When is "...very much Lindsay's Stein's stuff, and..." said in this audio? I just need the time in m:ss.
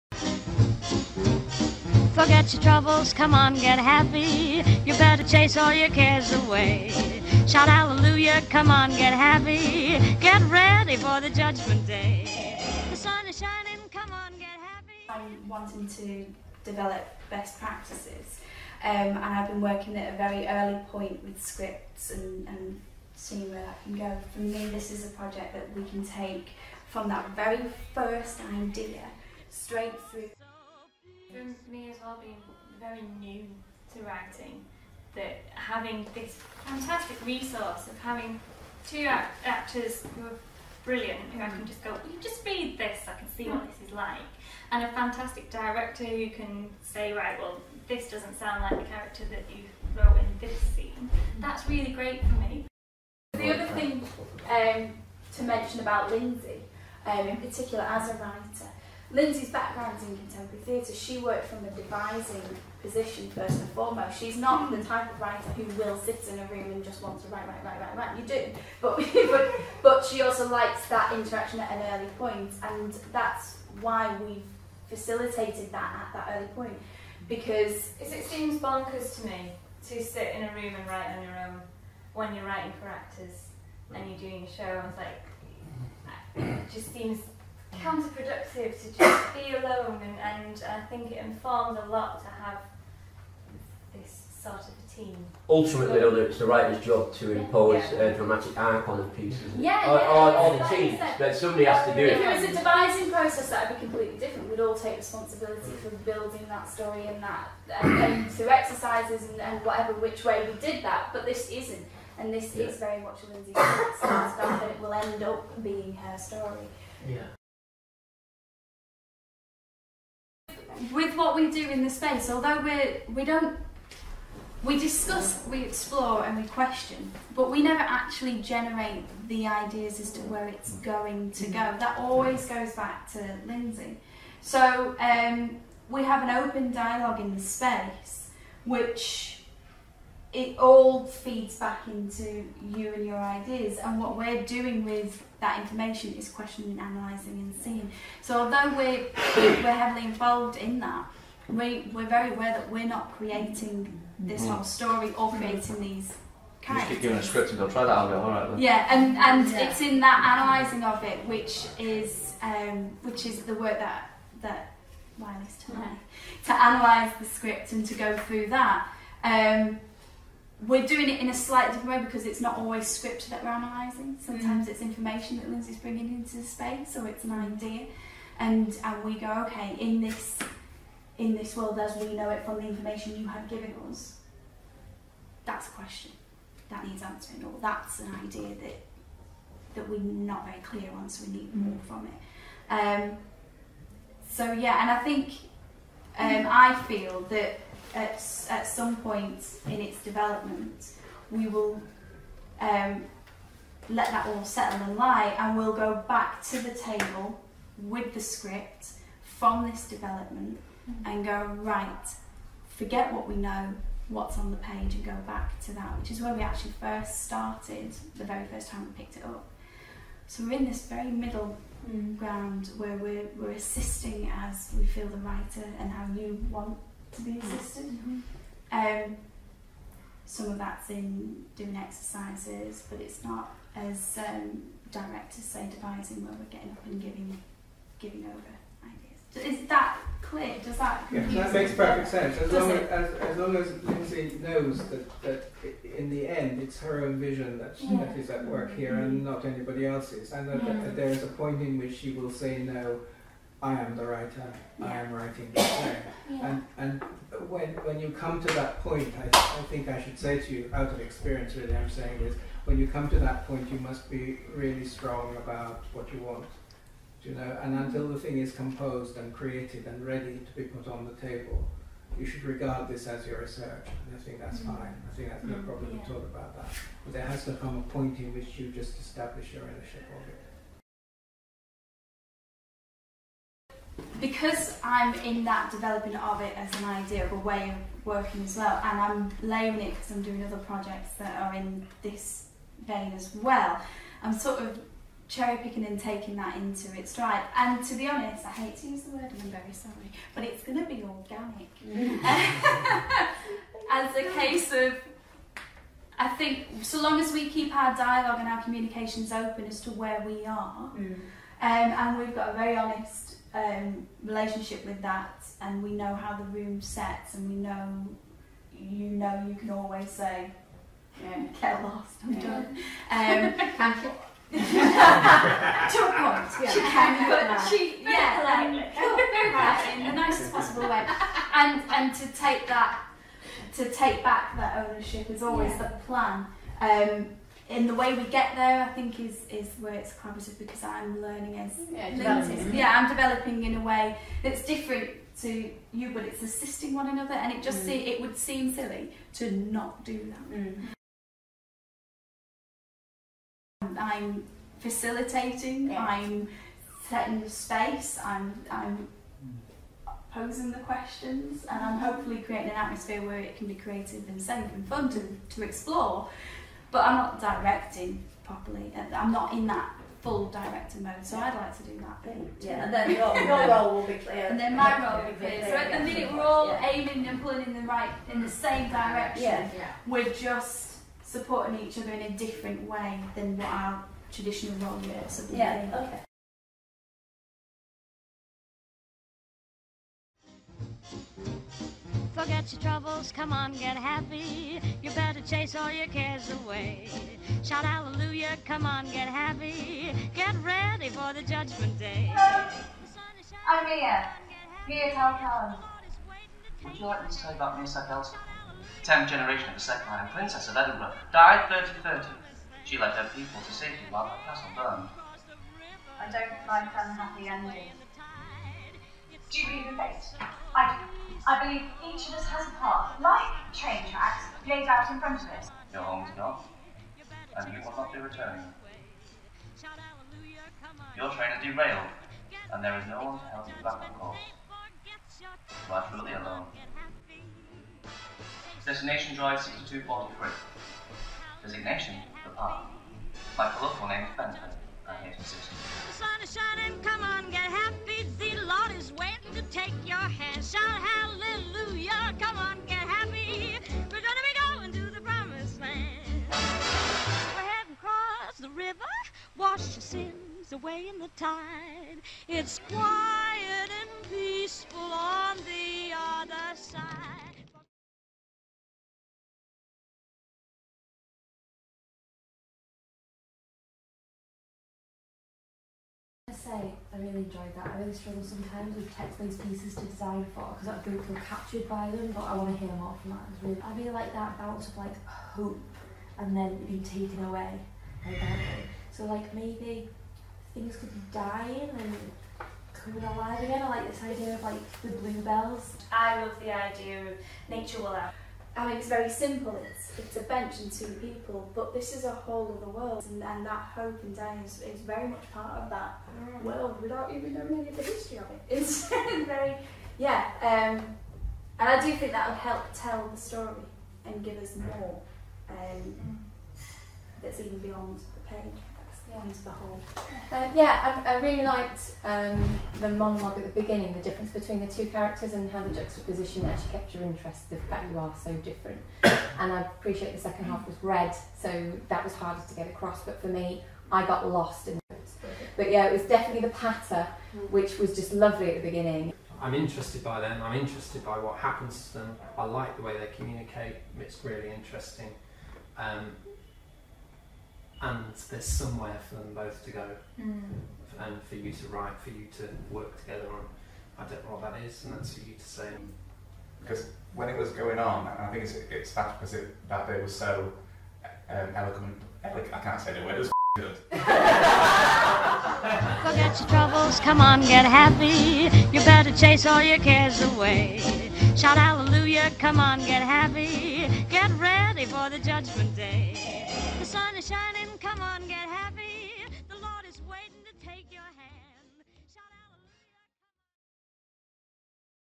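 1:52.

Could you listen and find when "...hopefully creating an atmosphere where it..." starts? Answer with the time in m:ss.
6:01.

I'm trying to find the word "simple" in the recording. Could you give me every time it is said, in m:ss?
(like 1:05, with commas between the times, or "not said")
8:19.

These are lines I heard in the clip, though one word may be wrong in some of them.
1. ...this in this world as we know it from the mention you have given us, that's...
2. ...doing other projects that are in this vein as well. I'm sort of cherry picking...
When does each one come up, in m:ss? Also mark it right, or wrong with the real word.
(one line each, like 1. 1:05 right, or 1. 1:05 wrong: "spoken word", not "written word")
1. 3:00 wrong: "information", not "mention"
2. 4:50 right.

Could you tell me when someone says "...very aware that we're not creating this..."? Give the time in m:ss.
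2:32.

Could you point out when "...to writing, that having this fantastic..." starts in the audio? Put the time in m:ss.
0:33.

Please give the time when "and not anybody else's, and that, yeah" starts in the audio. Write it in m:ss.
4:09.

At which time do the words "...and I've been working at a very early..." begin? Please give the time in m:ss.
0:18.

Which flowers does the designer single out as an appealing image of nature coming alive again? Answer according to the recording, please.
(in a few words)
bluebells.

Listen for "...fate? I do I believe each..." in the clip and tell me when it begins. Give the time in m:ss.
6:59.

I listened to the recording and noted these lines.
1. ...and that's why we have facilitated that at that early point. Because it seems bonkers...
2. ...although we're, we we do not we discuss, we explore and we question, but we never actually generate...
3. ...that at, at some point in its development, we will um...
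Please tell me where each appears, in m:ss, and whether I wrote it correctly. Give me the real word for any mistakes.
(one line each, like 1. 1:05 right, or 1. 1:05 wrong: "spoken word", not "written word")
1. 1:12 right
2. 2:02 right
3. 3:17 right.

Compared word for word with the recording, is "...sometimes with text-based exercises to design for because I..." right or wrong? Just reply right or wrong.
wrong.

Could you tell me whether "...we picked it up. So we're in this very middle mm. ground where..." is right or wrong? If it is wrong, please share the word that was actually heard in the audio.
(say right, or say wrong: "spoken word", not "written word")
right.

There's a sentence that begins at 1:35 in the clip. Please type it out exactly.
Ultimately, so, it's the writer's job to impose yeah.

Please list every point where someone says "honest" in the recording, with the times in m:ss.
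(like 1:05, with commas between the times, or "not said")
4:58, 5:12.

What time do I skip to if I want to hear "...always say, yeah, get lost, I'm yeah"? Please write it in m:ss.
5:19.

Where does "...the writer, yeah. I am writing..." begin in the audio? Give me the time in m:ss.
4:13.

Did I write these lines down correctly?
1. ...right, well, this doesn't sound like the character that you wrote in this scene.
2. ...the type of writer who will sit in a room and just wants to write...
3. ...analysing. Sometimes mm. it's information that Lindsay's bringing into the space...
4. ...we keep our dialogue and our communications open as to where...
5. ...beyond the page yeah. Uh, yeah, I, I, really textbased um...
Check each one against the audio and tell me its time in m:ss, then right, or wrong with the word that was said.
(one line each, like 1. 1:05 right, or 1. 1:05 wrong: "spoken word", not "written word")
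1. 0:47 right
2. 1:04 right
3. 2:53 right
4. 5:07 right
5. 8:37 wrong: "liked", not "textbased".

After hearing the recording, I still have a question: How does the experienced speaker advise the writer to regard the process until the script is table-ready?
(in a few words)
research.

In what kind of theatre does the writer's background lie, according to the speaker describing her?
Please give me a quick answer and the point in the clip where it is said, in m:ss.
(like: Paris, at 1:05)
contemporary theatre, at 1:00.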